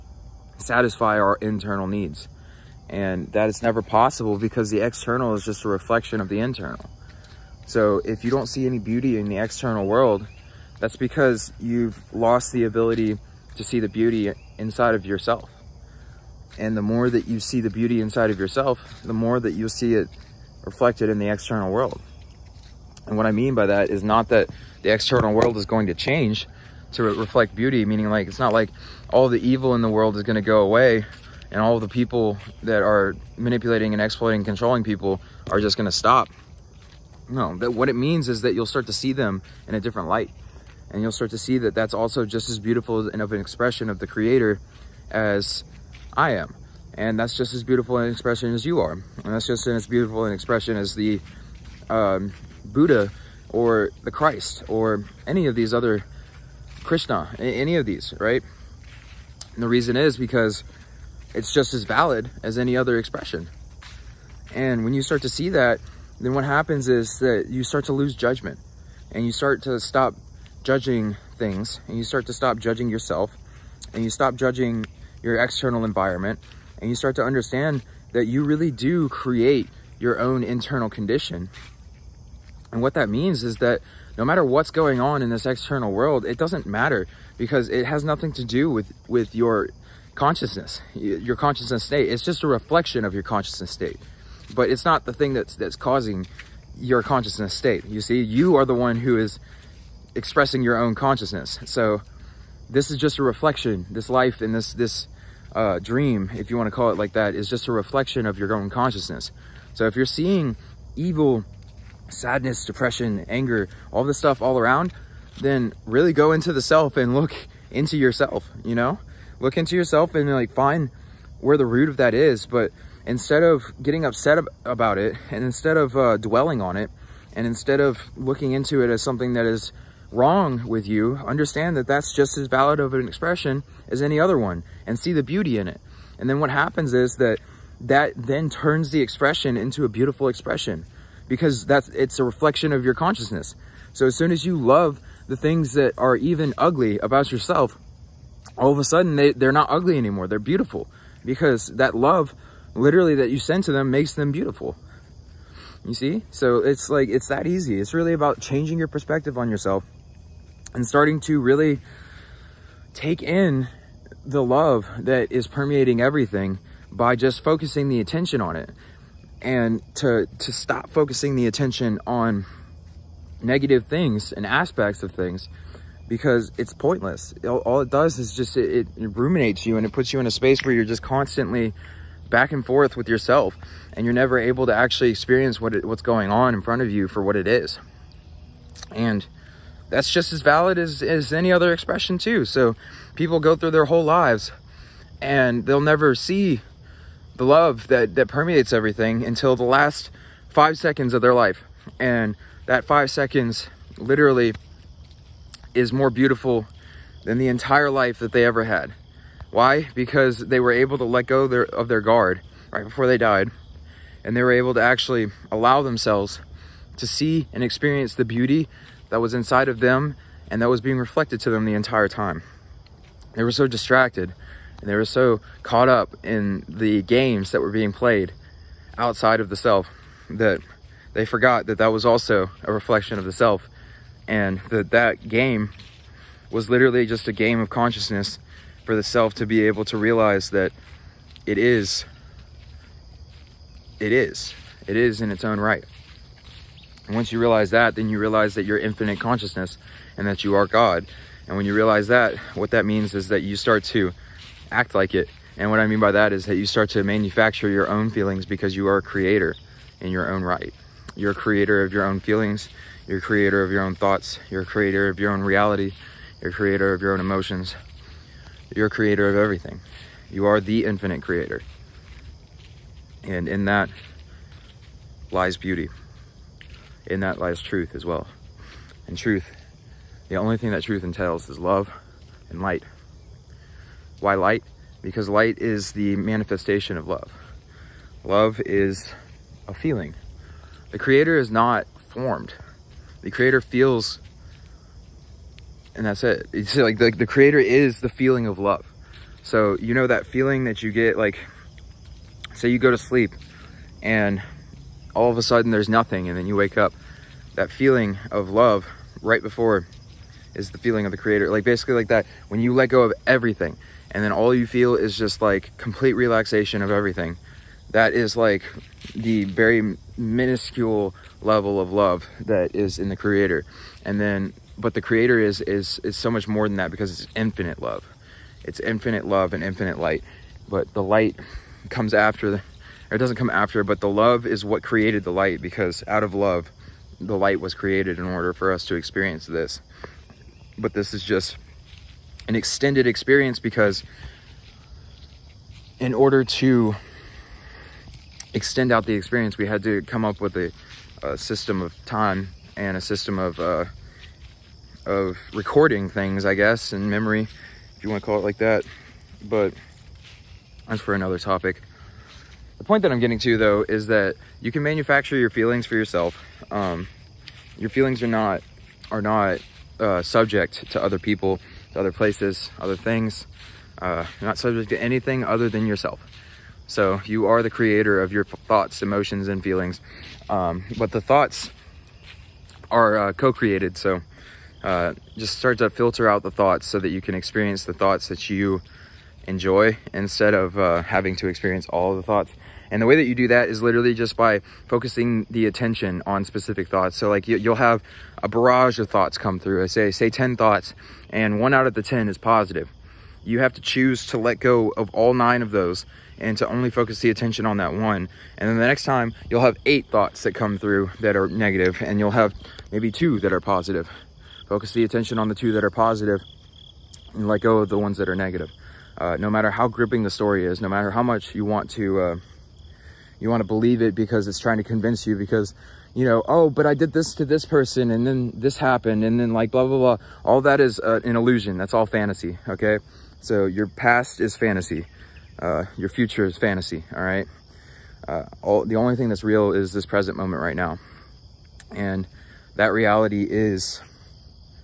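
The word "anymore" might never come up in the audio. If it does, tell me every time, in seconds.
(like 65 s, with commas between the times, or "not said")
149 s.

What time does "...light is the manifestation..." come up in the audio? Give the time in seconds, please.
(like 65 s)
285 s.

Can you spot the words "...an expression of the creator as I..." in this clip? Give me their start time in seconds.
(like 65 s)
43 s.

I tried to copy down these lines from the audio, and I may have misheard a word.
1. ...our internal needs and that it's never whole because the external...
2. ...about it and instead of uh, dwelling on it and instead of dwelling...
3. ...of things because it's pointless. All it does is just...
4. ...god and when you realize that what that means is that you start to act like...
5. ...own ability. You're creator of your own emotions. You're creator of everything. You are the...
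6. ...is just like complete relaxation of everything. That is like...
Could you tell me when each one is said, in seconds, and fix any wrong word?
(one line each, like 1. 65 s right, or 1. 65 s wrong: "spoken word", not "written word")
1. 1 s wrong: "possible", not "whole"
2. 124 s wrong: "looking", not "dwelling"
3. 175 s right
4. 250 s right
5. 265 s wrong: "reality", not "ability"
6. 314 s right.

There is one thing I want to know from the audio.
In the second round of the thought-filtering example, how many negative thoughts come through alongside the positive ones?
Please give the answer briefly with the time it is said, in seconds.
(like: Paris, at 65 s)
8, at 409 s.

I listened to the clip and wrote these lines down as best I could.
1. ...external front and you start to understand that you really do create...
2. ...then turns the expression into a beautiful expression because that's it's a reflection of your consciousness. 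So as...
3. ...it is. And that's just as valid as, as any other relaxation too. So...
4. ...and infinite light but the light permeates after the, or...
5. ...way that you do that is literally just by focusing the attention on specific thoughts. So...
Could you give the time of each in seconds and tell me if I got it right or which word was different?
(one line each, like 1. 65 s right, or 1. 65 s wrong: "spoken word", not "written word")
1. 75 s wrong: "environment", not "front"
2. 138 s right
3. 187 s wrong: "expression", not "relaxation"
4. 329 s wrong: "comes", not "permeates"
5. 393 s right.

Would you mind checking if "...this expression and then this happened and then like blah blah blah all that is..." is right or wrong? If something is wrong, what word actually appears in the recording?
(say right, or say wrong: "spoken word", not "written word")
wrong: "person", not "expression".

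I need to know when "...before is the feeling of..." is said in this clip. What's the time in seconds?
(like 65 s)
309 s.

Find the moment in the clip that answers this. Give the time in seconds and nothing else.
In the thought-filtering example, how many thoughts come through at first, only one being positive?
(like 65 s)
400 s.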